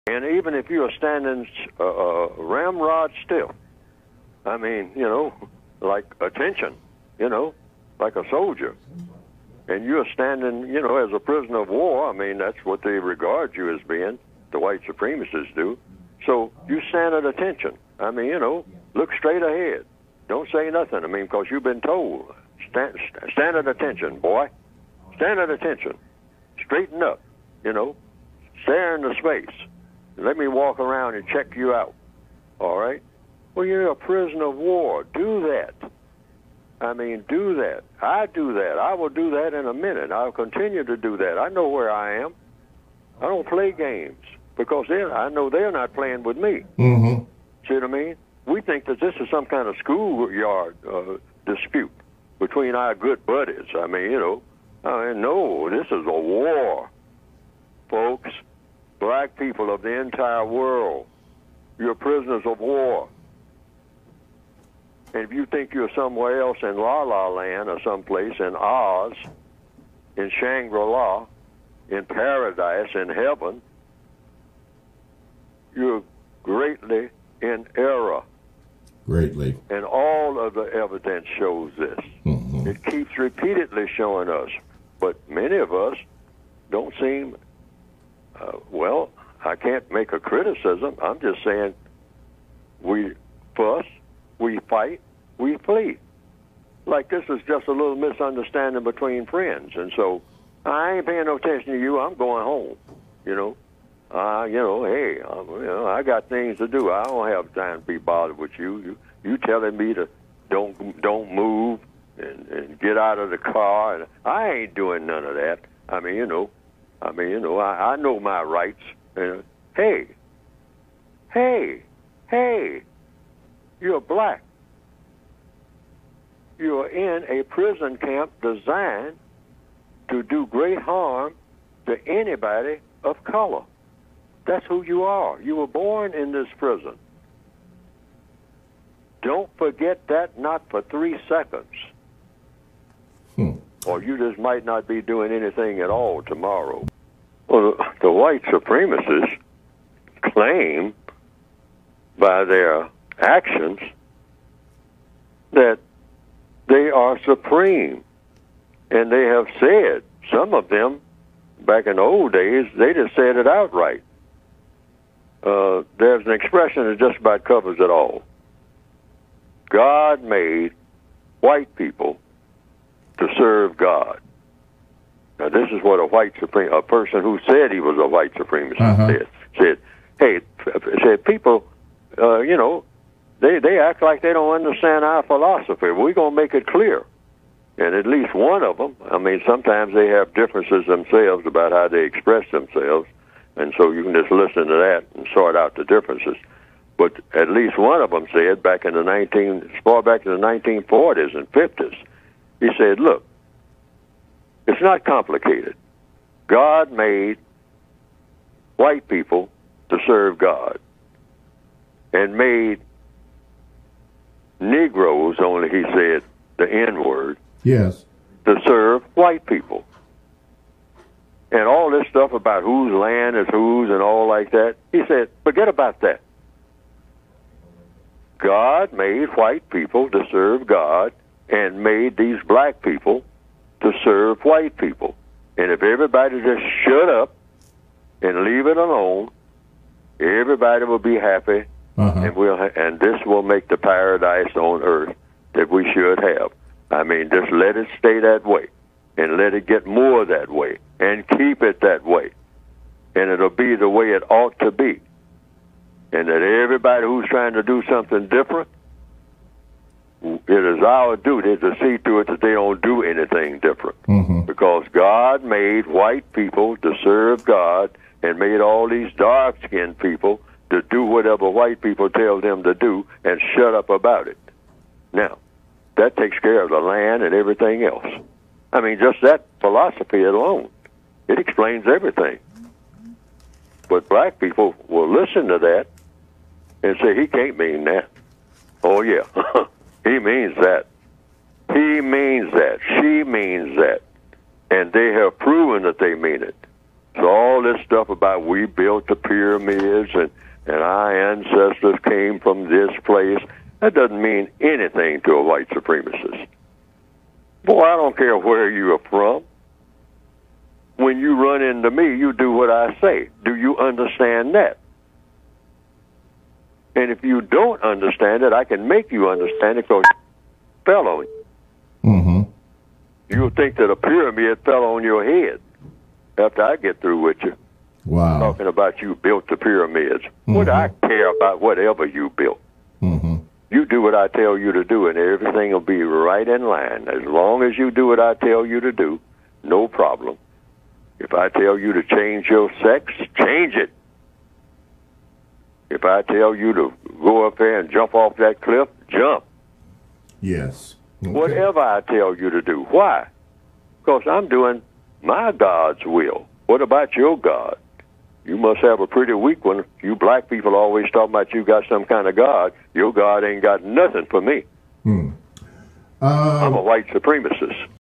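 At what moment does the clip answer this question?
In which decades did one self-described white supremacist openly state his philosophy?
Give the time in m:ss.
3:20.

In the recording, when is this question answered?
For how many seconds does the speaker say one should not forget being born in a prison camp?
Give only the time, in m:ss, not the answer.
2:20.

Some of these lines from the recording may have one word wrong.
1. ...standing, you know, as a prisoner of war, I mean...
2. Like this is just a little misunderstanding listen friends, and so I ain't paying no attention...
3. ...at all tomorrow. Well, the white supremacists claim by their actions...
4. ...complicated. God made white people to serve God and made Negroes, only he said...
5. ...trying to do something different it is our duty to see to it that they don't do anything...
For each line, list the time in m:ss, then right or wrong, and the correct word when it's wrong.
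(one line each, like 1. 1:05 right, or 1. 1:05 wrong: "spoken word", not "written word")
1. 0:10 right
2. 1:36 wrong: "between", not "listen"
3. 2:25 right
4. 3:25 right
5. 4:17 right.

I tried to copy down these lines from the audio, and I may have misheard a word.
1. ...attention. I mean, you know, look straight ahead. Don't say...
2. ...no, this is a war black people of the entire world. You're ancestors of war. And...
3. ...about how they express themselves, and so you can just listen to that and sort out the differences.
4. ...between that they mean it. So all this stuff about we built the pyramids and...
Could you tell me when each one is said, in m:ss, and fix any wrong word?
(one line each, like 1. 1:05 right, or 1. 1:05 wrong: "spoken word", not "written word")
1. 0:17 right
2. 0:55 wrong: "prisoners", not "ancestors"
3. 3:11 right
4. 4:55 wrong: "proven", not "between".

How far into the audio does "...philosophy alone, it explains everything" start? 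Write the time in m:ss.
4:39.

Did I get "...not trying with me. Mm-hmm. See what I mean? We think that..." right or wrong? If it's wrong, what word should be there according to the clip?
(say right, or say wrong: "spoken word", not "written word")
wrong: "playing", not "trying".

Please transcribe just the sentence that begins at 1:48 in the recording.
You you telling me to don't don't move and and get out of the car, and I ain't doing none of that.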